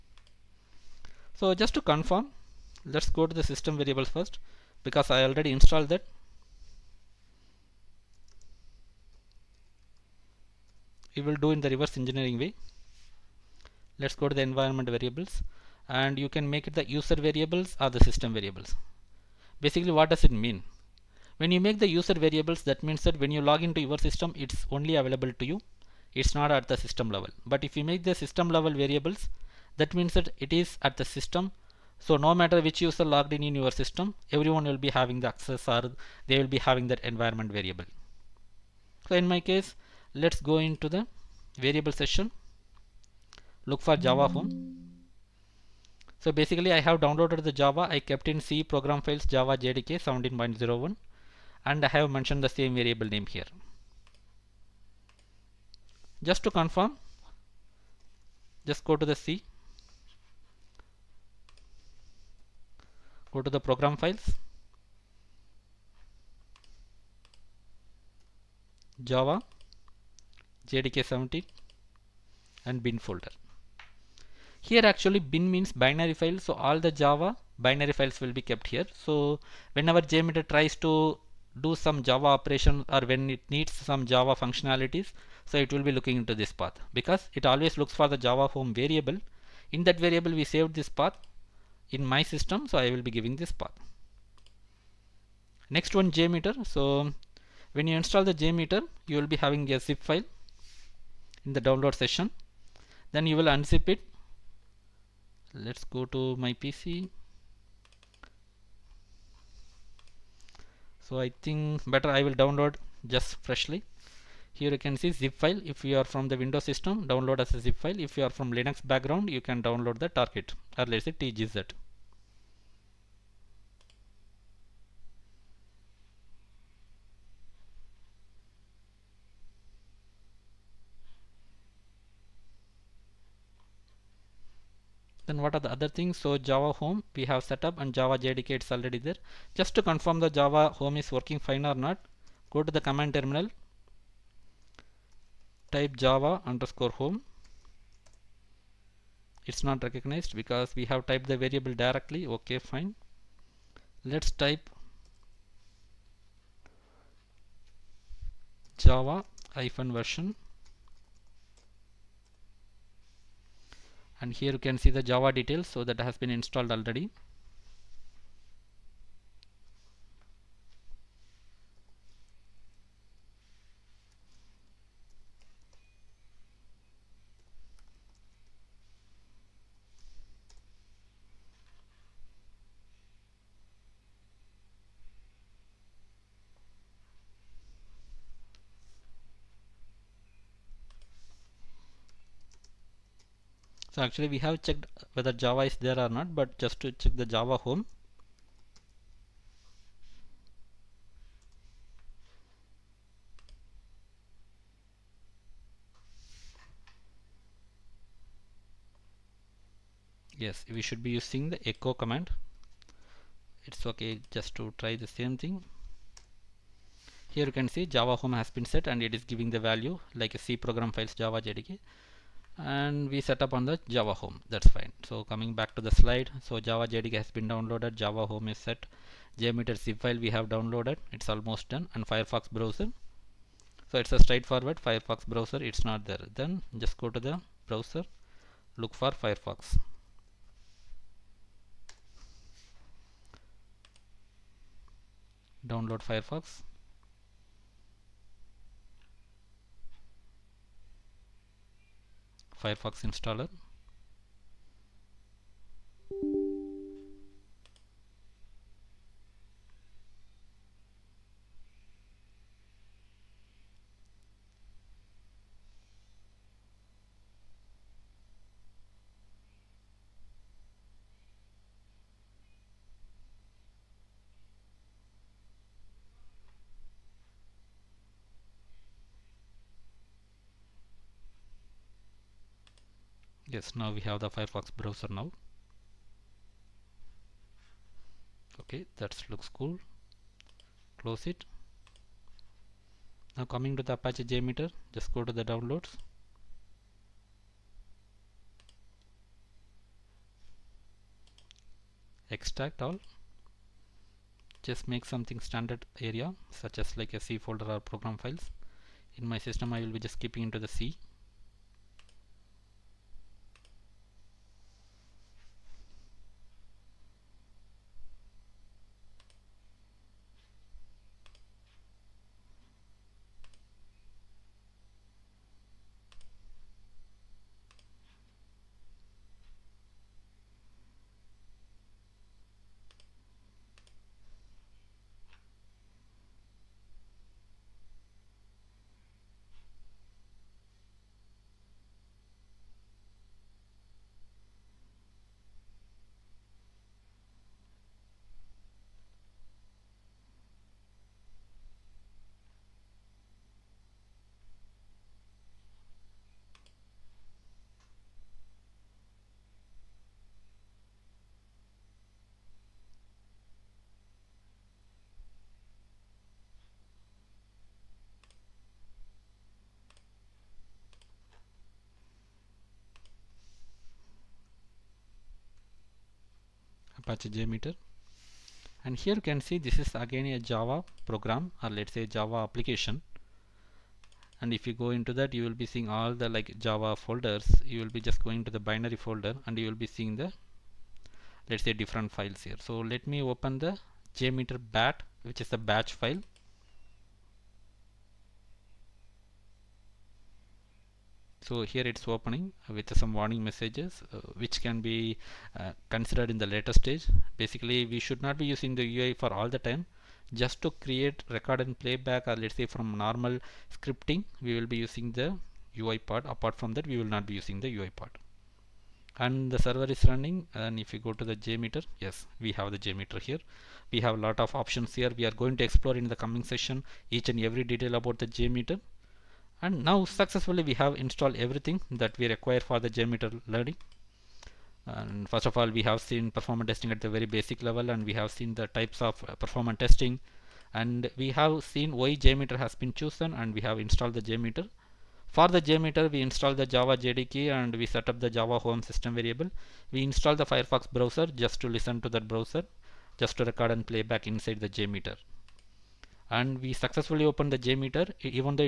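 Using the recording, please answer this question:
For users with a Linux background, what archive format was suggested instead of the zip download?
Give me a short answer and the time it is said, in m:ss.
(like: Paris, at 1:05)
tgz, at 2:01.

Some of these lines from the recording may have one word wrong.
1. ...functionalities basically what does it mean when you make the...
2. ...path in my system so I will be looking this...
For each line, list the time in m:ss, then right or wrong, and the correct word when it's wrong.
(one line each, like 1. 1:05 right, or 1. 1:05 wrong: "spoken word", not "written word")
1. 0:18 wrong: "variables", not "functionalities"
2. 1:31 wrong: "giving", not "looking".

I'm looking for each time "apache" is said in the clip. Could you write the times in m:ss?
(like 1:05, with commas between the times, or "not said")
4:53, 6:17.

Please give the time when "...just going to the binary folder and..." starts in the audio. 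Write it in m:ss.
6:28.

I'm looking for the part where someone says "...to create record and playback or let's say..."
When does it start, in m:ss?
6:50.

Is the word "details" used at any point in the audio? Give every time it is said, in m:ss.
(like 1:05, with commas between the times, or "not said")
2:45, 7:07.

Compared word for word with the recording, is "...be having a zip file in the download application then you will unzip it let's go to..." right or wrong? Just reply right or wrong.
wrong.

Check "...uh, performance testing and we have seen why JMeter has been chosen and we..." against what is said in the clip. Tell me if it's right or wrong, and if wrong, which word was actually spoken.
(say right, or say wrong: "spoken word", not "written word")
right.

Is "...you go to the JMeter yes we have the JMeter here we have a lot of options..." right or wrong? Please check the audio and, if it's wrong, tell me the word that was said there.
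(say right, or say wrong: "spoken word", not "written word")
right.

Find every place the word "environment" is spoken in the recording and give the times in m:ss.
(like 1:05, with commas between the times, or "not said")
0:14, 0:37.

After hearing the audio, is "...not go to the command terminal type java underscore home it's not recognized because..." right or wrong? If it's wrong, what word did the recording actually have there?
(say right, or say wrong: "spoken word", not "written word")
right.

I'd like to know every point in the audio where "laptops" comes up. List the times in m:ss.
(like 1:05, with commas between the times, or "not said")
not said.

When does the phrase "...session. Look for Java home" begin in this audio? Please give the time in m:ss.
0:41.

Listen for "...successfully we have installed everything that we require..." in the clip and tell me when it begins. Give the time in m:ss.
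7:10.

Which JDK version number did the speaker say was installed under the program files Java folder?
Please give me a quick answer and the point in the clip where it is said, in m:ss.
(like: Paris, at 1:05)
17.01, at 0:50.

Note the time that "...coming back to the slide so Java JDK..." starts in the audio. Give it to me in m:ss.
3:45.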